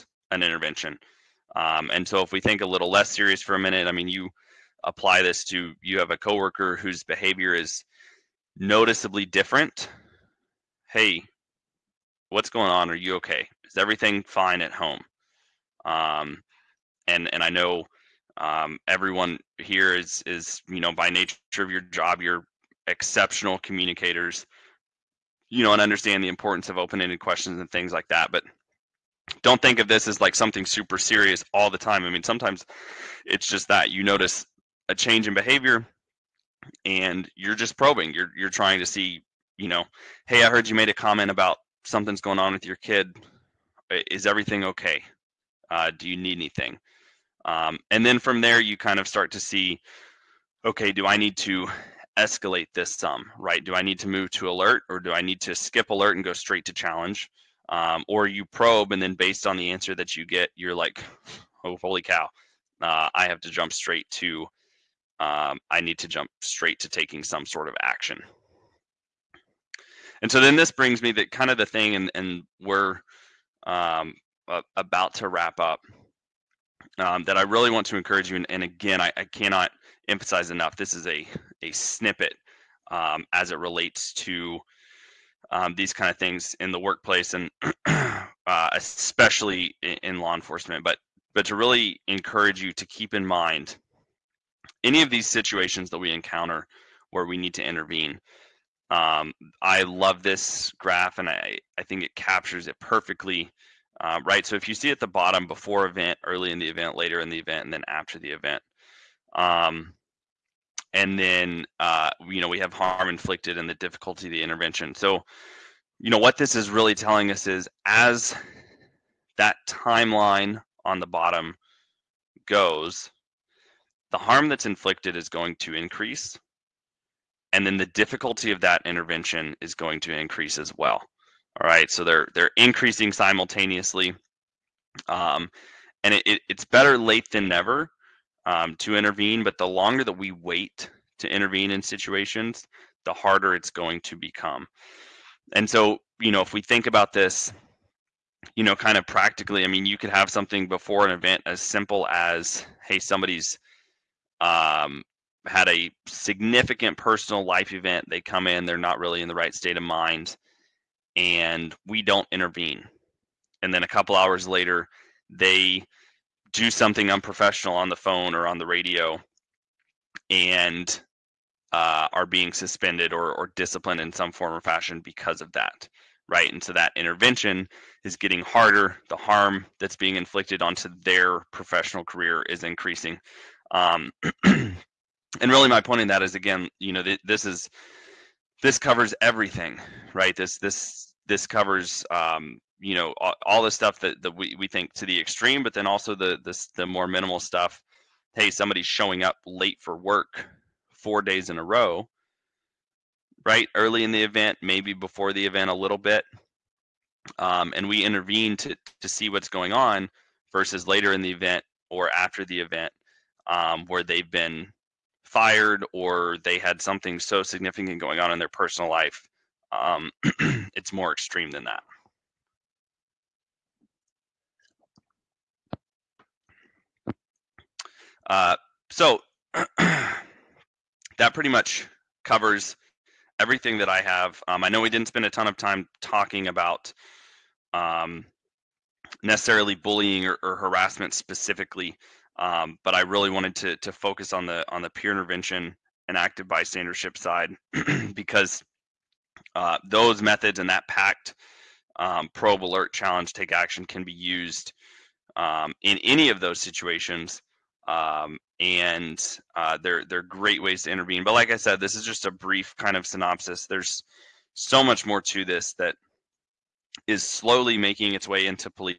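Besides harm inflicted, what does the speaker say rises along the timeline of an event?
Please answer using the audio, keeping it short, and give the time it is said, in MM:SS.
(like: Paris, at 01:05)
Difficulty of the intervention, at 02:07.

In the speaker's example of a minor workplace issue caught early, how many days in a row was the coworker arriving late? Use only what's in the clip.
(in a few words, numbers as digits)
4.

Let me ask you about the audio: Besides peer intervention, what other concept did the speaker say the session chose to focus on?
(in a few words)
Active bystandership.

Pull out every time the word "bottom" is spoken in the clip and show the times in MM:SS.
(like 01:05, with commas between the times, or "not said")
01:45, 02:01.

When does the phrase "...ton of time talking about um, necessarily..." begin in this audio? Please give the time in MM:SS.
03:55.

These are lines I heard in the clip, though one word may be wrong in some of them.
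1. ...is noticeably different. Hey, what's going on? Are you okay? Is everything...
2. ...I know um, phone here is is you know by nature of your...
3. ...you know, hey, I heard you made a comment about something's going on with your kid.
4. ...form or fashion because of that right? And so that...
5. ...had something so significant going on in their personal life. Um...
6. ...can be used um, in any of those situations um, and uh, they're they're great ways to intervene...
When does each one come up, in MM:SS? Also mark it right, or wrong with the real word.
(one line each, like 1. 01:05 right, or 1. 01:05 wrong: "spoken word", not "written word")
1. 00:07 right
2. 00:17 wrong: "everyone", not "phone"
3. 00:39 right
4. 02:54 right
5. 03:36 right
6. 04:13 right.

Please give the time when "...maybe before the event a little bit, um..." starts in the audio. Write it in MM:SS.
03:24.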